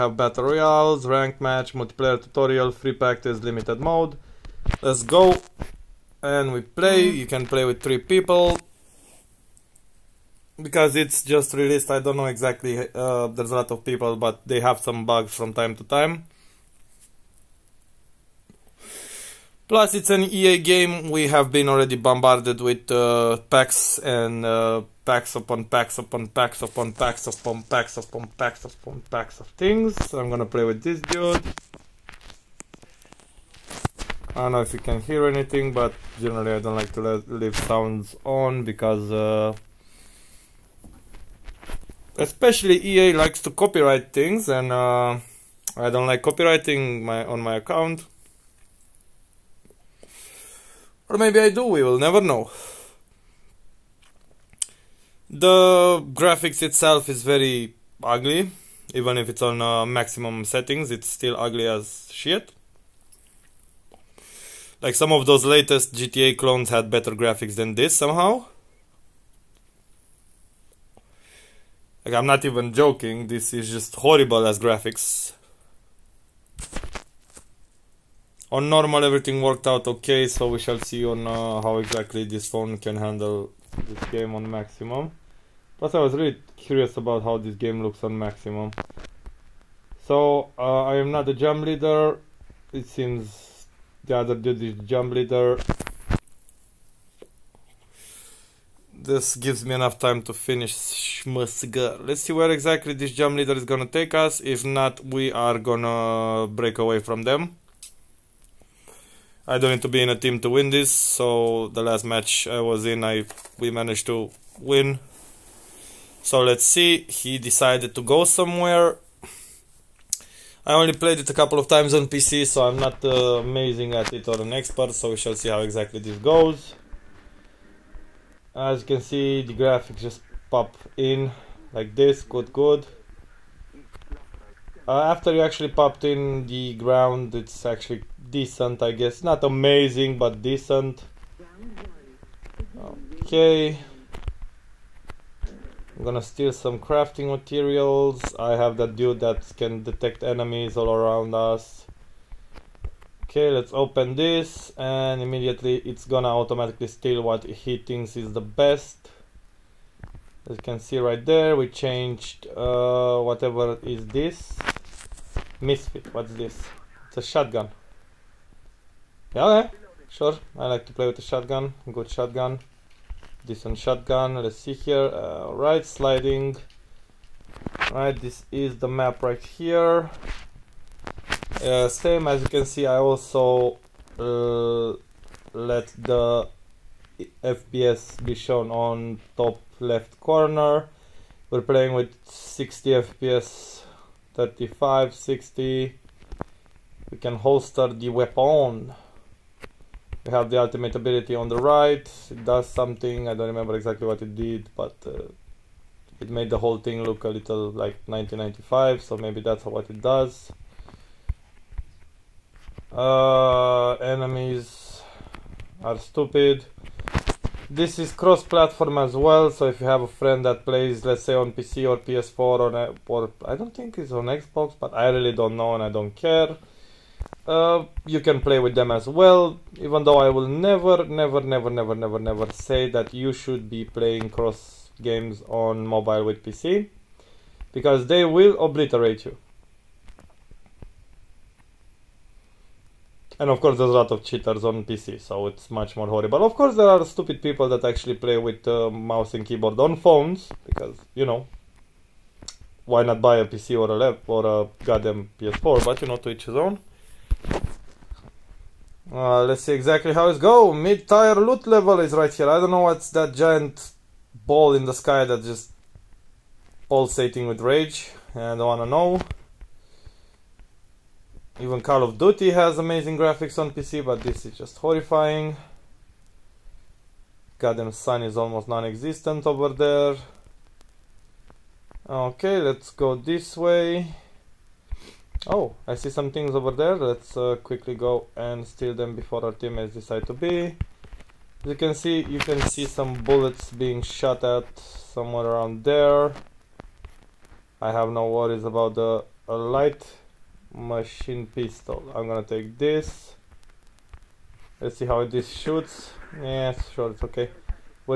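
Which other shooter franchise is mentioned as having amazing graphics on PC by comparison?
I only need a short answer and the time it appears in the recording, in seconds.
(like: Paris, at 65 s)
Call of Duty, at 271 s.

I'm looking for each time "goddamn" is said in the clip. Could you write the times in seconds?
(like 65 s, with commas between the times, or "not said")
254 s, 277 s.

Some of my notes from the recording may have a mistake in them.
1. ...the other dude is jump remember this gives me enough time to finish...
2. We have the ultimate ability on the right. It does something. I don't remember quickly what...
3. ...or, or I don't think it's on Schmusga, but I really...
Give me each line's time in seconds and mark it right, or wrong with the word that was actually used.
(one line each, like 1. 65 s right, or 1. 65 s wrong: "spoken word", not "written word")
1. 94 s wrong: "leader", not "remember"
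2. 200 s wrong: "exactly", not "quickly"
3. 222 s wrong: "Xbox", not "Schmusga".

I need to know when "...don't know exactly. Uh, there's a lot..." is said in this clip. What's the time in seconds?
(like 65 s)
11 s.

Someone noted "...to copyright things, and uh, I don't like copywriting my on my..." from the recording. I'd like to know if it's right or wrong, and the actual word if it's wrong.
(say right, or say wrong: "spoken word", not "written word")
right.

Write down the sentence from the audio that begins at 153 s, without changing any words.
Okay, let's open this and immediately it's gonna automatically steal what he thinks is the best.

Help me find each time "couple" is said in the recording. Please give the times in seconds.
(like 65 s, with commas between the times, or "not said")
121 s.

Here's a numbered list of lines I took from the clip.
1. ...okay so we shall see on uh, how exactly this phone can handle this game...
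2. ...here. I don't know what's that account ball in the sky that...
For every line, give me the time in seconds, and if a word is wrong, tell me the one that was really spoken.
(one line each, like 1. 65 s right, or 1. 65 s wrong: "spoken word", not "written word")
1. 79 s right
2. 262 s wrong: "giant", not "account".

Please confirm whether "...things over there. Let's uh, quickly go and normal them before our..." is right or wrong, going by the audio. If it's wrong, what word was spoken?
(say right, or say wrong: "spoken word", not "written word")
wrong: "steal", not "normal".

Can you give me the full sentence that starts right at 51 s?
Or maybe I do, we will never know.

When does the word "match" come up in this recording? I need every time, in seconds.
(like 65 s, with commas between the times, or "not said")
1 s, 112 s.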